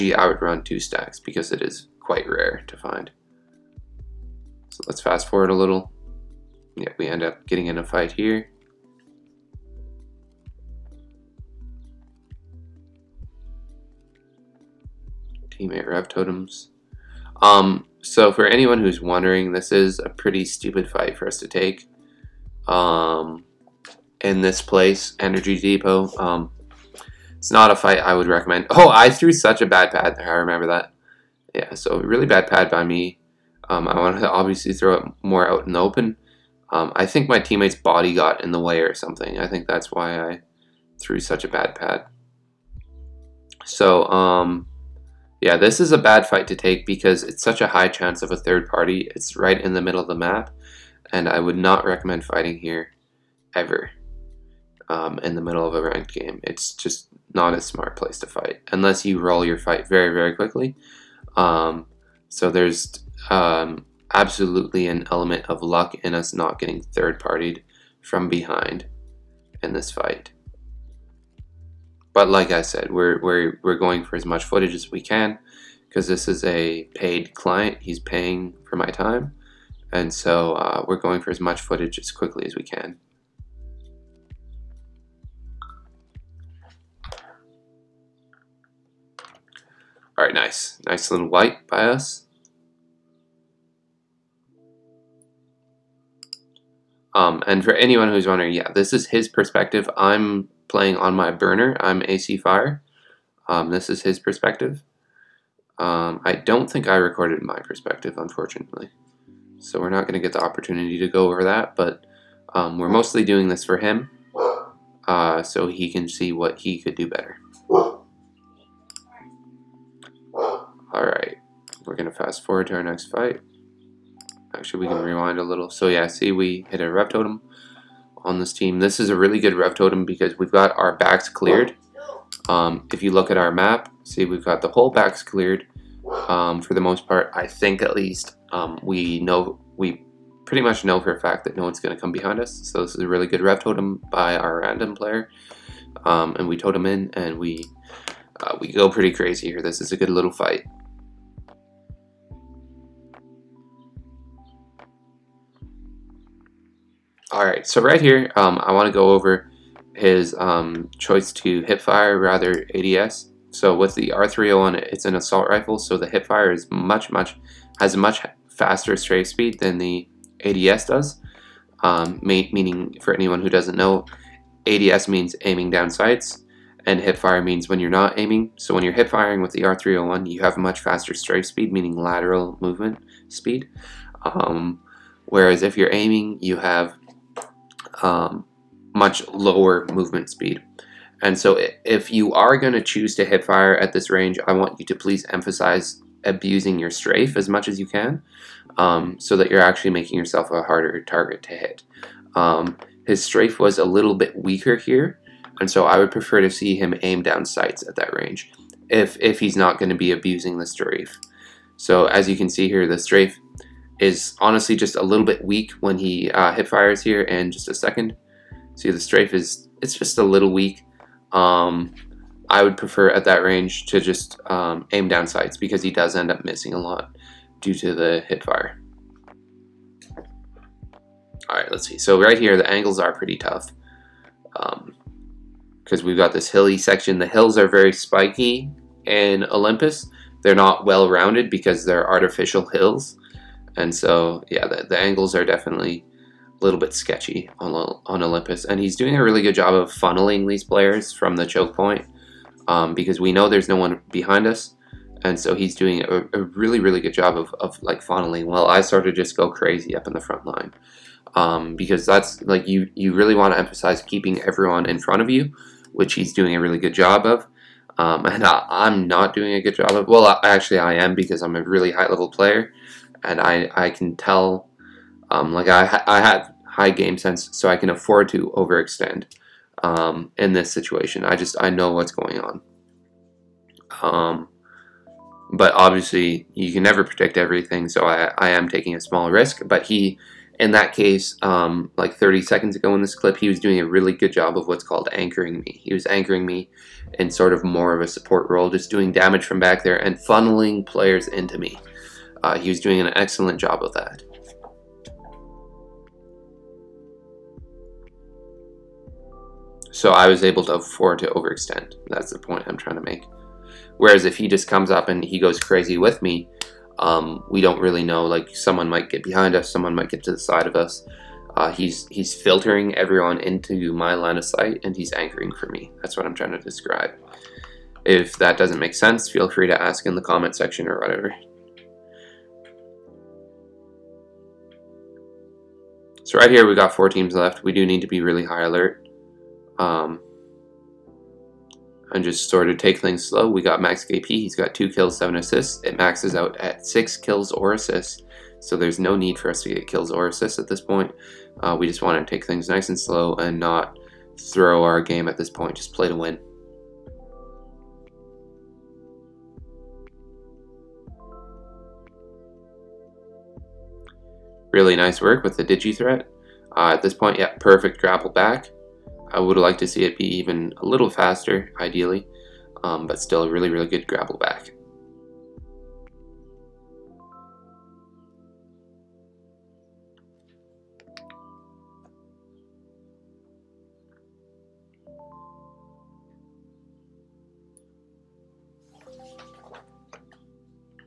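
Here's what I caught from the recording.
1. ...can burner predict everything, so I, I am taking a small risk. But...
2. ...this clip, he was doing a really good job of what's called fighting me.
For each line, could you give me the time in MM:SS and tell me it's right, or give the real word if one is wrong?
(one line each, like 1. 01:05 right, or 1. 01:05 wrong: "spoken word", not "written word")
1. 04:46 wrong: "never", not "burner"
2. 04:53 wrong: "anchoring", not "fighting".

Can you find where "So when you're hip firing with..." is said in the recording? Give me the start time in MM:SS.
02:58.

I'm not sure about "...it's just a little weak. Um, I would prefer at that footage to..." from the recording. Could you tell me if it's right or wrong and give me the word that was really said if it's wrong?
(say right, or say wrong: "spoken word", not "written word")
wrong: "range", not "footage".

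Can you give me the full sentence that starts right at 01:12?
But like I said, we're, we're, we're going for as much footage as we can because this is a paid client.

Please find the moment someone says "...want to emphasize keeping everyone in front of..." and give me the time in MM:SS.
04:23.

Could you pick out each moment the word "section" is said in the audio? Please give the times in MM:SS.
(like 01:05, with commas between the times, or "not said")
03:56, 05:30.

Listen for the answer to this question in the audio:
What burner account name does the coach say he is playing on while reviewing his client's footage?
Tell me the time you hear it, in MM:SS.
01:42.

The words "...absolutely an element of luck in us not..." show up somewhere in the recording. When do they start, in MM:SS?
01:04.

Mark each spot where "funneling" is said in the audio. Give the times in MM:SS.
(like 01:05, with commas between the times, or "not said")
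04:09, 04:18, 05:00.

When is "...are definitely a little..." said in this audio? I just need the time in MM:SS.
04:05.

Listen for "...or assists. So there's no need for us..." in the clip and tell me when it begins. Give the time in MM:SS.
05:47.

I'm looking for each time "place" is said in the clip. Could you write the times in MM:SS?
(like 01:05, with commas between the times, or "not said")
00:24, 00:57.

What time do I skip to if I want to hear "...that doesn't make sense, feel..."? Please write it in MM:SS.
05:28.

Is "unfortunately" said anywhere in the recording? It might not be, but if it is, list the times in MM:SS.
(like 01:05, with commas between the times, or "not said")
01:48.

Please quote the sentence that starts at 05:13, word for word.
Whereas if he just comes up and he goes crazy with me, um, we don't really know.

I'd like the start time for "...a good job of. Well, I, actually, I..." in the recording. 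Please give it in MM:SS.
04:29.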